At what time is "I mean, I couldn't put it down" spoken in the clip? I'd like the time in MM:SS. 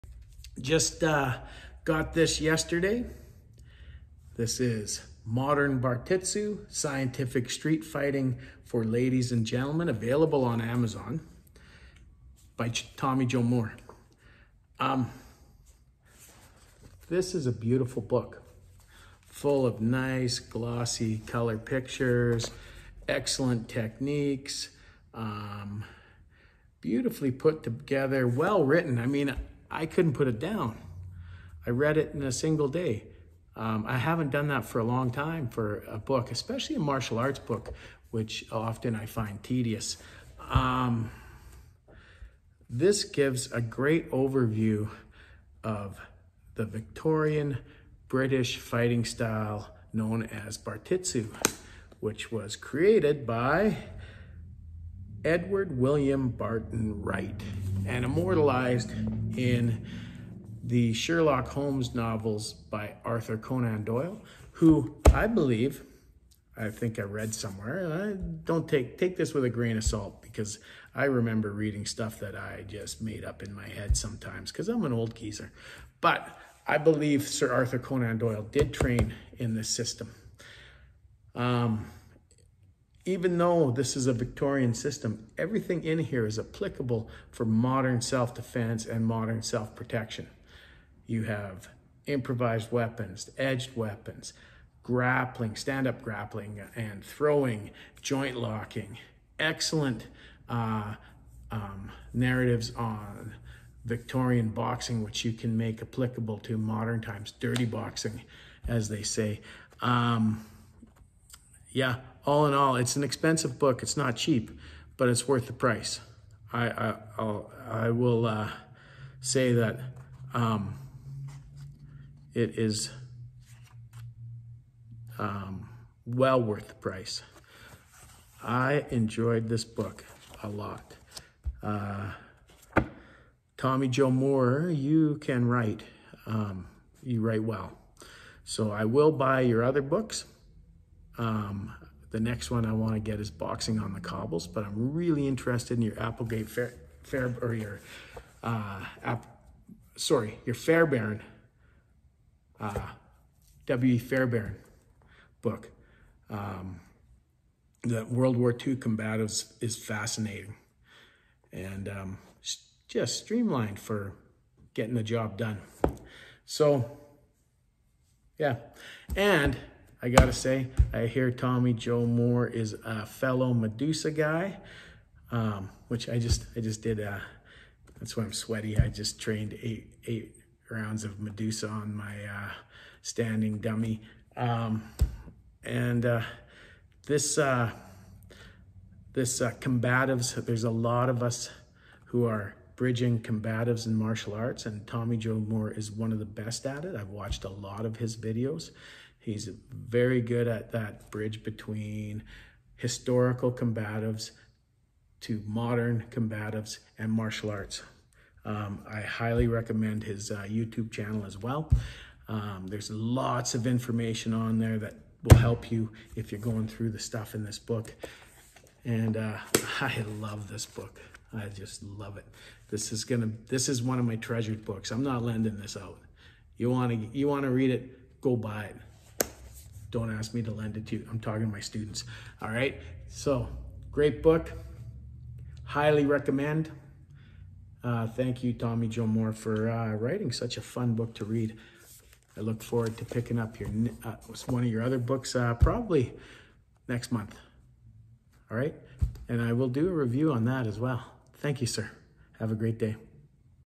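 00:28.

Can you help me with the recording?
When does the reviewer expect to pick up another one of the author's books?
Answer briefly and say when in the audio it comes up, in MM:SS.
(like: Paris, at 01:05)
Next month, at 04:06.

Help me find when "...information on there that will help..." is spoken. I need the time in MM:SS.
03:33.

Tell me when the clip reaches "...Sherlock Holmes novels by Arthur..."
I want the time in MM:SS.
01:00.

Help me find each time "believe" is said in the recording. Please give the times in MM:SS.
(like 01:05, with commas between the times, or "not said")
01:05, 01:16.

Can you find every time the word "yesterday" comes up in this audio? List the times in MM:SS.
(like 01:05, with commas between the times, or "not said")
00:02.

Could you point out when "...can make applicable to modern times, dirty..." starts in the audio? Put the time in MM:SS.
01:45.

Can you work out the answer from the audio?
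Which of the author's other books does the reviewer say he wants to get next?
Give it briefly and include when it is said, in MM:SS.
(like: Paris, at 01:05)
Boxing on the Cobbles, at 02:23.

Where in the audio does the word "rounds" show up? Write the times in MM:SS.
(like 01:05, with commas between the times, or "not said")
03:00.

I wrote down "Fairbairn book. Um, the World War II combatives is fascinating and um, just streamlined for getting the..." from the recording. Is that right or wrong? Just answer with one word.
right.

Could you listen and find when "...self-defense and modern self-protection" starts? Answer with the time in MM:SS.
01:28.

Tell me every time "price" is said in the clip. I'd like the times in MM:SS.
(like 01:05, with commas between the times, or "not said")
01:55, 02:06.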